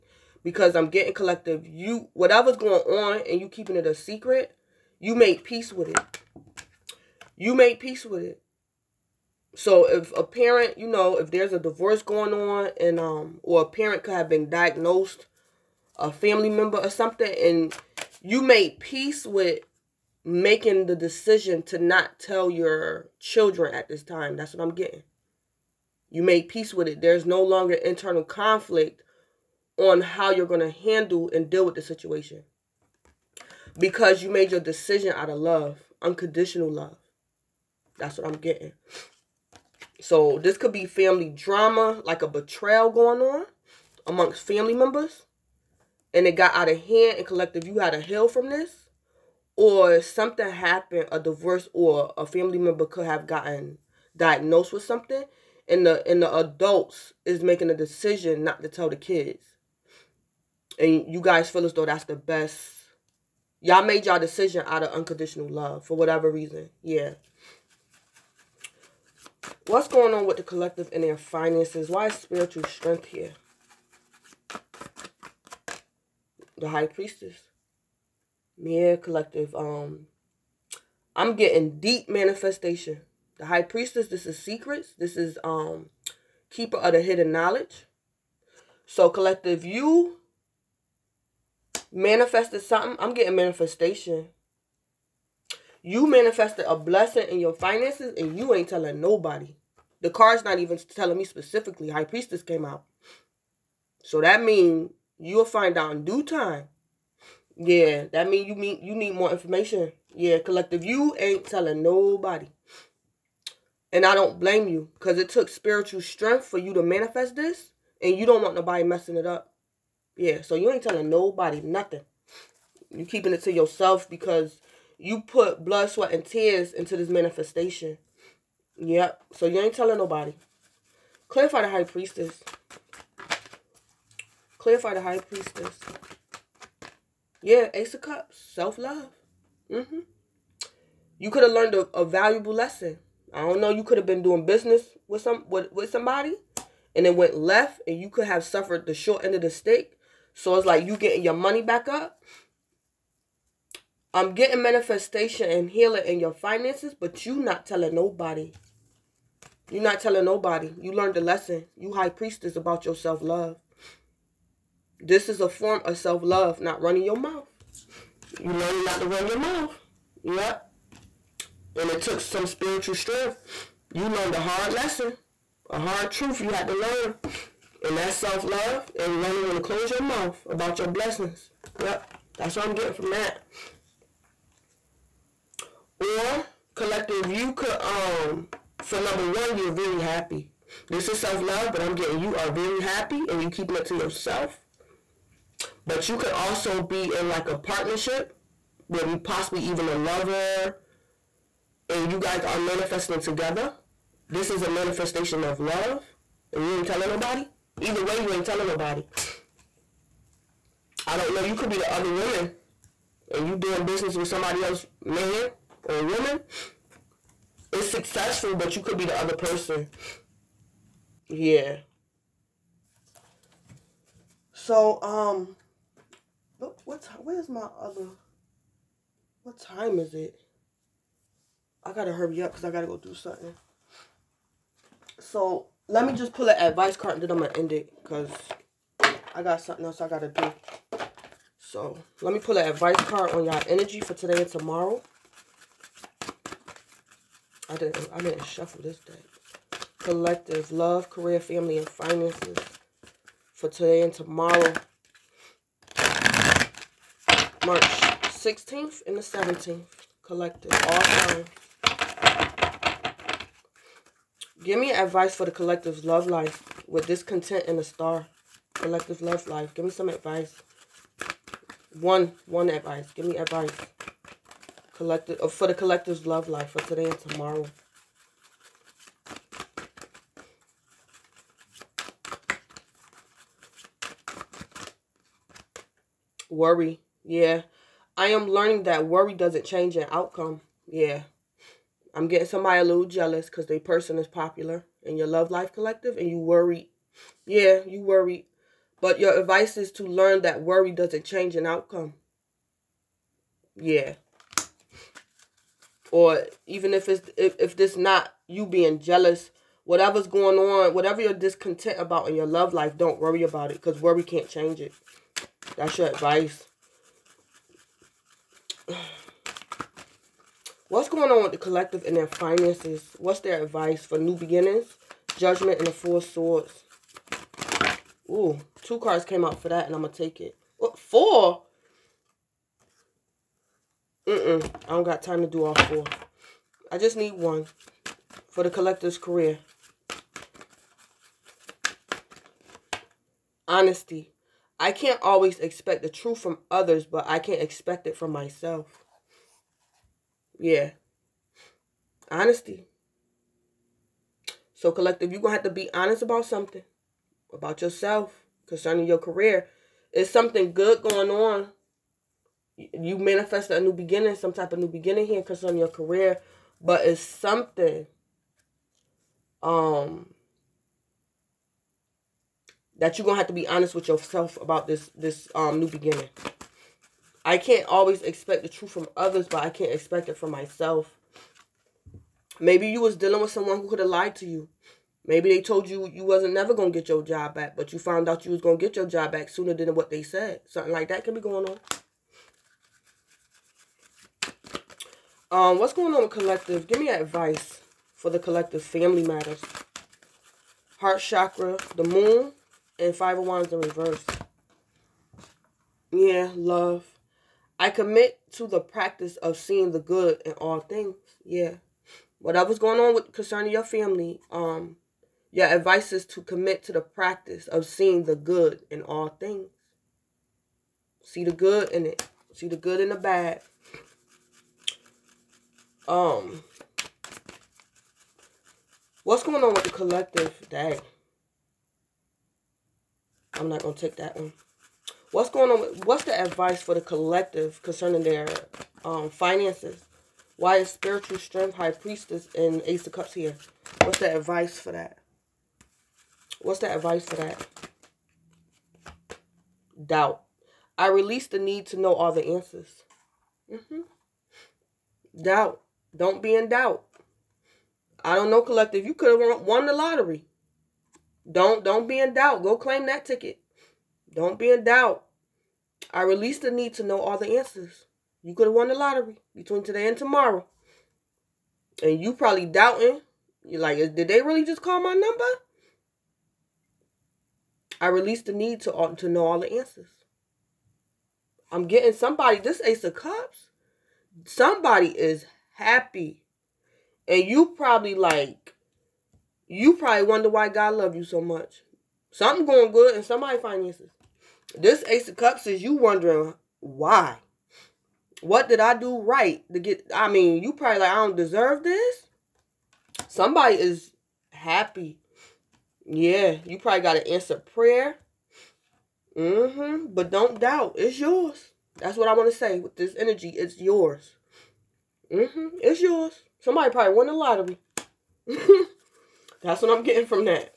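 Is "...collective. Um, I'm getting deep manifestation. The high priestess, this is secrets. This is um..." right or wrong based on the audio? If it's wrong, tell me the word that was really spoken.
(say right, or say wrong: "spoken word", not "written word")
right.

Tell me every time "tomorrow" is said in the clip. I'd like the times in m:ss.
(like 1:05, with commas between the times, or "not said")
4:04, 4:14, 4:37, 7:50.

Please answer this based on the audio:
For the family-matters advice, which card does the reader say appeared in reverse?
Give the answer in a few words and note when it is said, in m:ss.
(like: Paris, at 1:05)
Five of Wands, at 6:43.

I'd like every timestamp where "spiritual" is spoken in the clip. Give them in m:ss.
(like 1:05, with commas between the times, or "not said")
1:12, 1:55, 2:52, 7:20.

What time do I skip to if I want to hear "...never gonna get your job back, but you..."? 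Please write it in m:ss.
6:26.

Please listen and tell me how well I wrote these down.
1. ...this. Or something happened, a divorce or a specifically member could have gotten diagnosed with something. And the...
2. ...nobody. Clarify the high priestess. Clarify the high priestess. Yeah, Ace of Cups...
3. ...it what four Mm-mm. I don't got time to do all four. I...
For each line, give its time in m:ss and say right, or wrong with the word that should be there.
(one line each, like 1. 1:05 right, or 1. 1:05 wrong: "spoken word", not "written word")
1. 0:48 wrong: "family", not "specifically"
2. 2:09 right
3. 5:30 right.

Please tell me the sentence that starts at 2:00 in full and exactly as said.
Yeah, so you ain't telling nobody nothing.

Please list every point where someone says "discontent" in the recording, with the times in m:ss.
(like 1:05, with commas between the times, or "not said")
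4:27, 5:11.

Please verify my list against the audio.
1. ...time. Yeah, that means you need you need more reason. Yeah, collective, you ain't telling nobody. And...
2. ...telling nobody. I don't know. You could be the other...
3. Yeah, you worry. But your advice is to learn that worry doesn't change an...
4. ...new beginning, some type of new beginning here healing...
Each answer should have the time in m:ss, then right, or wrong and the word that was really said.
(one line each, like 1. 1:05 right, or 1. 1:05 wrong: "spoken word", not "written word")
1. 1:46 wrong: "information", not "reason"
2. 3:28 right
3. 4:57 right
4. 6:03 wrong: "concerning", not "healing".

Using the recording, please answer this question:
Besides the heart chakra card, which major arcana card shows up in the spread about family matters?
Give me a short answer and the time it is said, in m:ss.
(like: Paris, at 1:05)
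The Moon, at 6:41.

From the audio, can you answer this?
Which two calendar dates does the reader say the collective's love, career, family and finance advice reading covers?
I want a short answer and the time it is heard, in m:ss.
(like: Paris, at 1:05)
March 16 and 17, at 4:17.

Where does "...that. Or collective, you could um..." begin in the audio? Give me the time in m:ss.
3:03.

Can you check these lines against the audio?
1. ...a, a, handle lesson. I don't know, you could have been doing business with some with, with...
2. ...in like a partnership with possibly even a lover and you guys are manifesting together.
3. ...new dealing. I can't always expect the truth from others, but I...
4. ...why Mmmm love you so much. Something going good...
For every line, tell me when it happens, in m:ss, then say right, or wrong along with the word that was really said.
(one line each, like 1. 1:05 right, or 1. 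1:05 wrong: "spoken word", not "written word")
1. 2:21 wrong: "valuable", not "handle"
2. 3:17 right
3. 6:15 wrong: "beginning", not "dealing"
4. 8:10 wrong: "God", not "Mmmm".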